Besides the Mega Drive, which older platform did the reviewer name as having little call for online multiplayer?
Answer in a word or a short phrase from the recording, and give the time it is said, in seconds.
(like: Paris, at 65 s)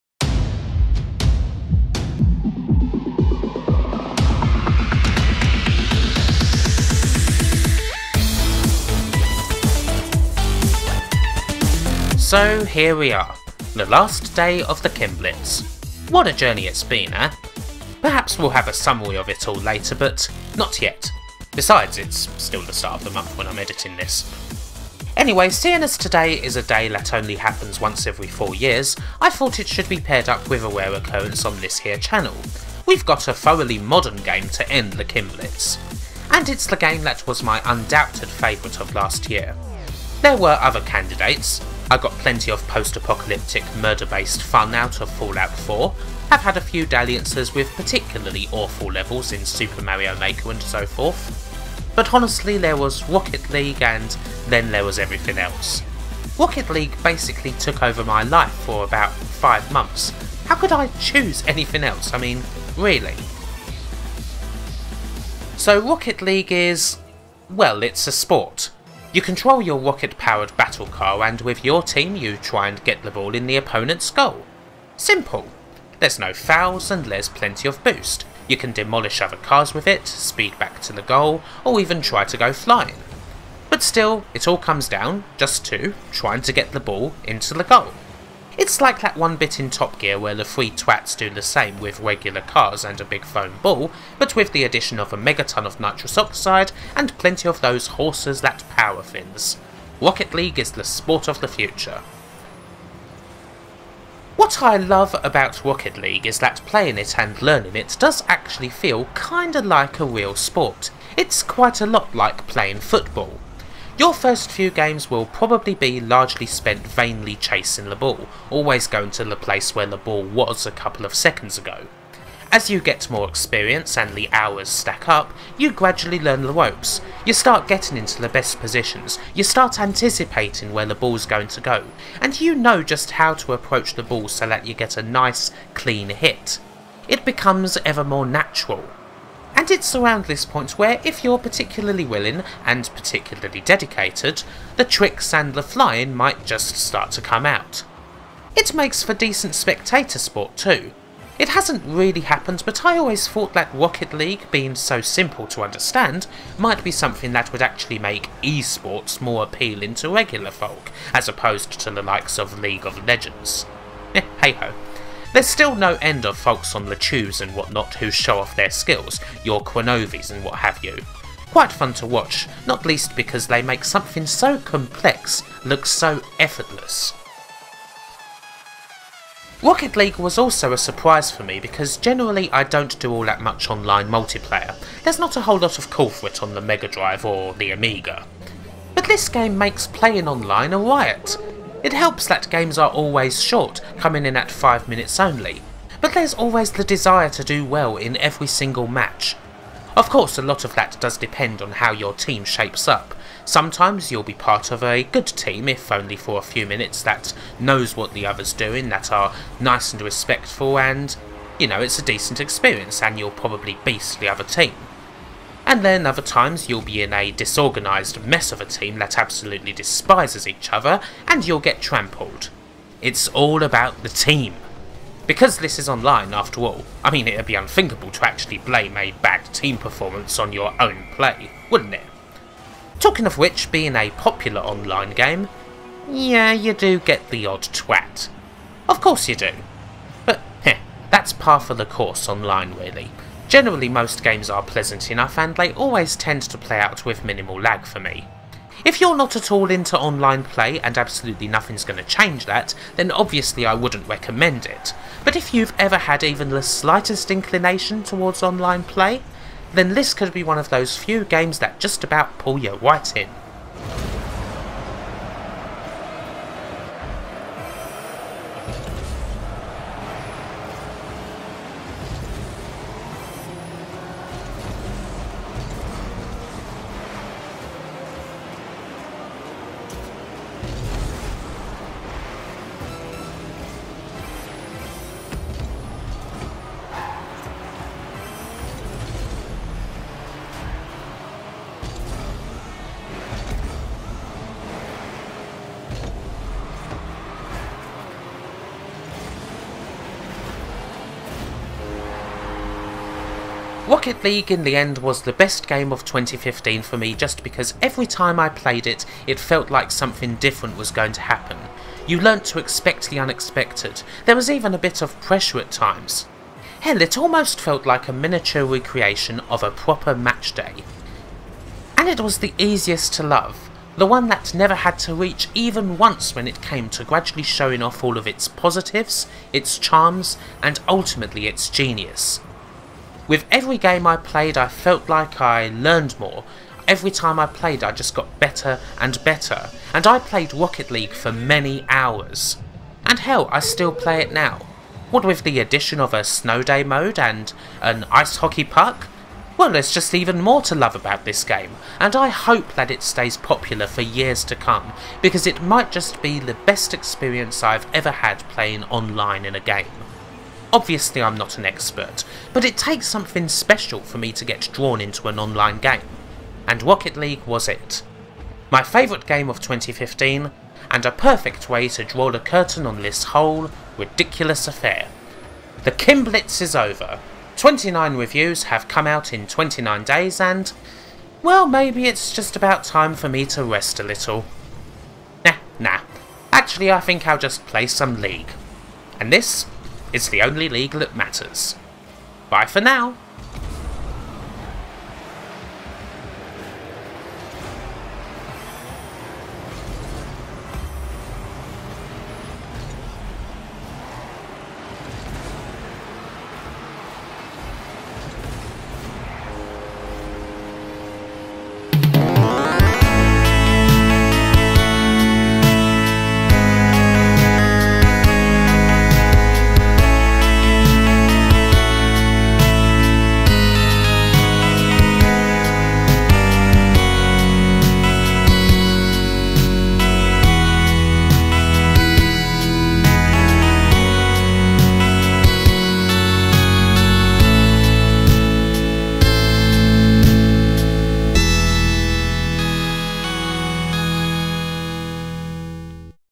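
Amiga, at 187 s.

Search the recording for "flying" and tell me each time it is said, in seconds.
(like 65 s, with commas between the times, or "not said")
82 s, 145 s.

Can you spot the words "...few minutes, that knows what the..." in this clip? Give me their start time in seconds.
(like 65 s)
206 s.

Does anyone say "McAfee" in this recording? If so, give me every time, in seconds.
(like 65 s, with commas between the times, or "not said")
not said.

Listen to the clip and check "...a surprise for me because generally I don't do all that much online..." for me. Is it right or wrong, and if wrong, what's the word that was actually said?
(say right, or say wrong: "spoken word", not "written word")
right.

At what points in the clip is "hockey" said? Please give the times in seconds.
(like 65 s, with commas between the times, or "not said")
348 s.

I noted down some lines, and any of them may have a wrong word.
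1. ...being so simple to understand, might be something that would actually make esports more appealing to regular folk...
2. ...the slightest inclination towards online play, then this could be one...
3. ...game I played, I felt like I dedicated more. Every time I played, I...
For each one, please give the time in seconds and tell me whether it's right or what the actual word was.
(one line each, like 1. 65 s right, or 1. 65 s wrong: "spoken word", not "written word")
1. 154 s right
2. 256 s right
3. 333 s wrong: "learned", not "dedicated".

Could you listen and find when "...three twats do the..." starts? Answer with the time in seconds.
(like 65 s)
90 s.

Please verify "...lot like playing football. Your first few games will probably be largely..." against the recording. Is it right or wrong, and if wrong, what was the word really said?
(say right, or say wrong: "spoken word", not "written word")
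right.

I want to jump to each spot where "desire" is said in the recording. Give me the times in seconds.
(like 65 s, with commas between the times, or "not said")
196 s.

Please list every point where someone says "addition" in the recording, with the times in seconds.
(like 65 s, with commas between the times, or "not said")
94 s, 345 s.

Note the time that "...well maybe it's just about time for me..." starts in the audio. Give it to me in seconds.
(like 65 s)
381 s.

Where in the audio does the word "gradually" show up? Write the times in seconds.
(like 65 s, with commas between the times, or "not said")
125 s, 327 s.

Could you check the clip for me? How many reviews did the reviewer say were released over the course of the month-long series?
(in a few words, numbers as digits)
29.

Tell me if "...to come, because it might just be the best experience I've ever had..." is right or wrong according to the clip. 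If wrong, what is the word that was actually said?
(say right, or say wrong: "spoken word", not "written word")
right.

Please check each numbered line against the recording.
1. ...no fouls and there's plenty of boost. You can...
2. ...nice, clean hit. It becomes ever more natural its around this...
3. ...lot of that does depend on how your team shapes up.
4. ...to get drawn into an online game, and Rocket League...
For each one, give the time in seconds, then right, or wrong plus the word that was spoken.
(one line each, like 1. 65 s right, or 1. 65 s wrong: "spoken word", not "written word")
1. 76 s right
2. 135 s right
3. 200 s right
4. 364 s right.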